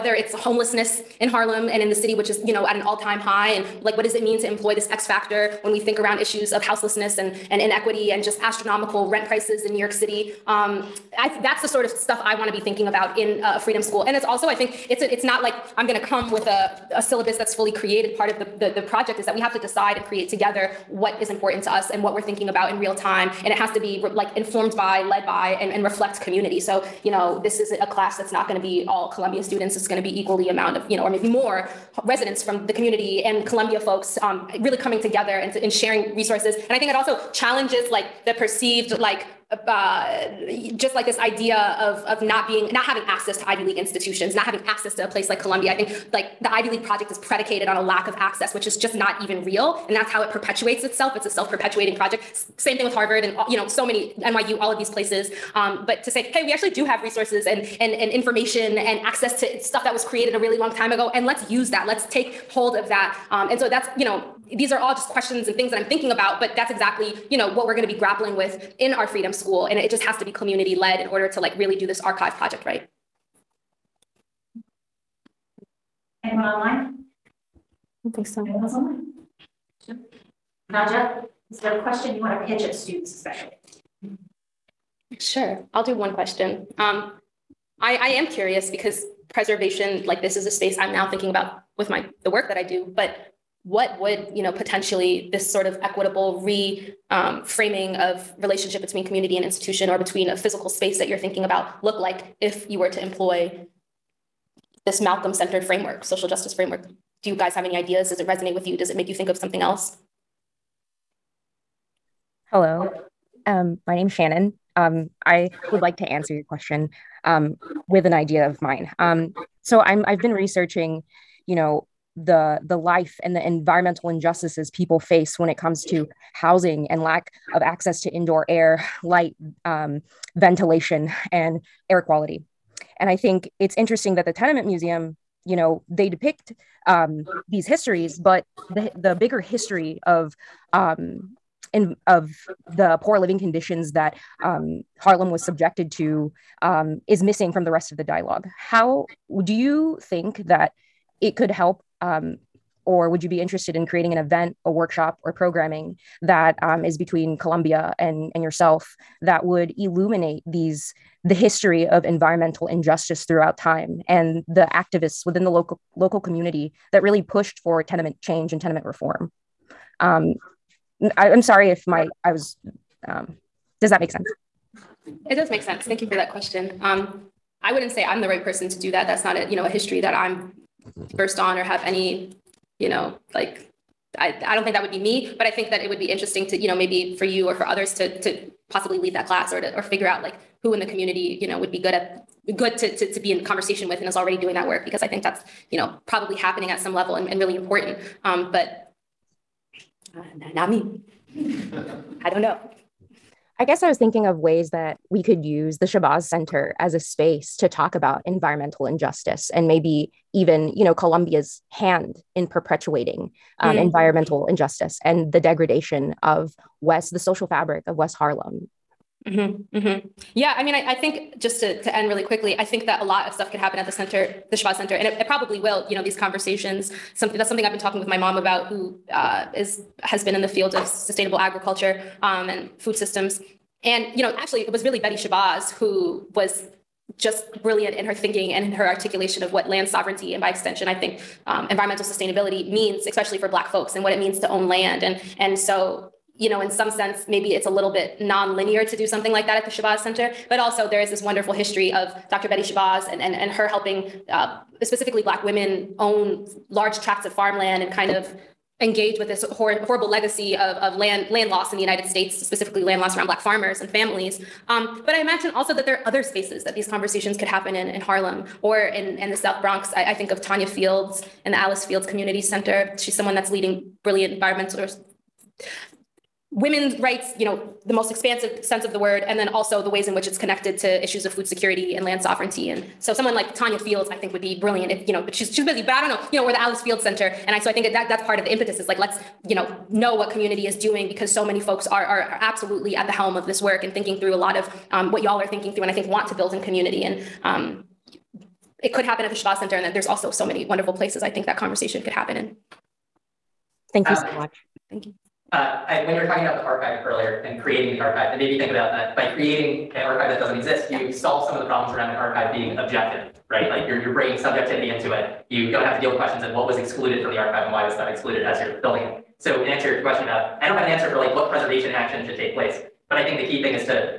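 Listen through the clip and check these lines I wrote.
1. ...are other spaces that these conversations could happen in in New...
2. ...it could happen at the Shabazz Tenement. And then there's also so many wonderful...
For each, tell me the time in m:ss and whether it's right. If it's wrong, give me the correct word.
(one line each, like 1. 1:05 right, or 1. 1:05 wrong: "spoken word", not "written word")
1. 4:25 wrong: "Harlem", not "New"
2. 4:58 wrong: "Center", not "Tenement".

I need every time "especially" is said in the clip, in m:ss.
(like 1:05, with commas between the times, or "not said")
1:23, 4:03.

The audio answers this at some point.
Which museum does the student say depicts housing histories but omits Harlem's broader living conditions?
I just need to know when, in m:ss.
2:14.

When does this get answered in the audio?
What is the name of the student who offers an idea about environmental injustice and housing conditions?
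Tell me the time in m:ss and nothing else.
1:54.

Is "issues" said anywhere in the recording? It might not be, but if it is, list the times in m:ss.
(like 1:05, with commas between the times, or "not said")
0:06, 4:41.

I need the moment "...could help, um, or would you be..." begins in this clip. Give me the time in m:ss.
2:31.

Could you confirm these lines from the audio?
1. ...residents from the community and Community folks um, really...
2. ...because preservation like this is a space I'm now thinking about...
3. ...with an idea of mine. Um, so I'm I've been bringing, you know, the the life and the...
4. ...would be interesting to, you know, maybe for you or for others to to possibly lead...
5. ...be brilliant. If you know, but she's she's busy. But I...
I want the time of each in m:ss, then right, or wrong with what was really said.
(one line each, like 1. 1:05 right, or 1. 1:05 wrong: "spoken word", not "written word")
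1. 0:32 wrong: "Columbia", not "Community"
2. 1:28 right
3. 1:57 wrong: "researching", not "bringing"
4. 3:05 right
5. 4:44 right.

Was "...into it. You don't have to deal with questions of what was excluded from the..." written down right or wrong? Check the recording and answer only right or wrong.
right.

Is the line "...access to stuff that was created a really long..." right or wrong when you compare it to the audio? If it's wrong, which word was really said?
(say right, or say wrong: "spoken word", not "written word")
right.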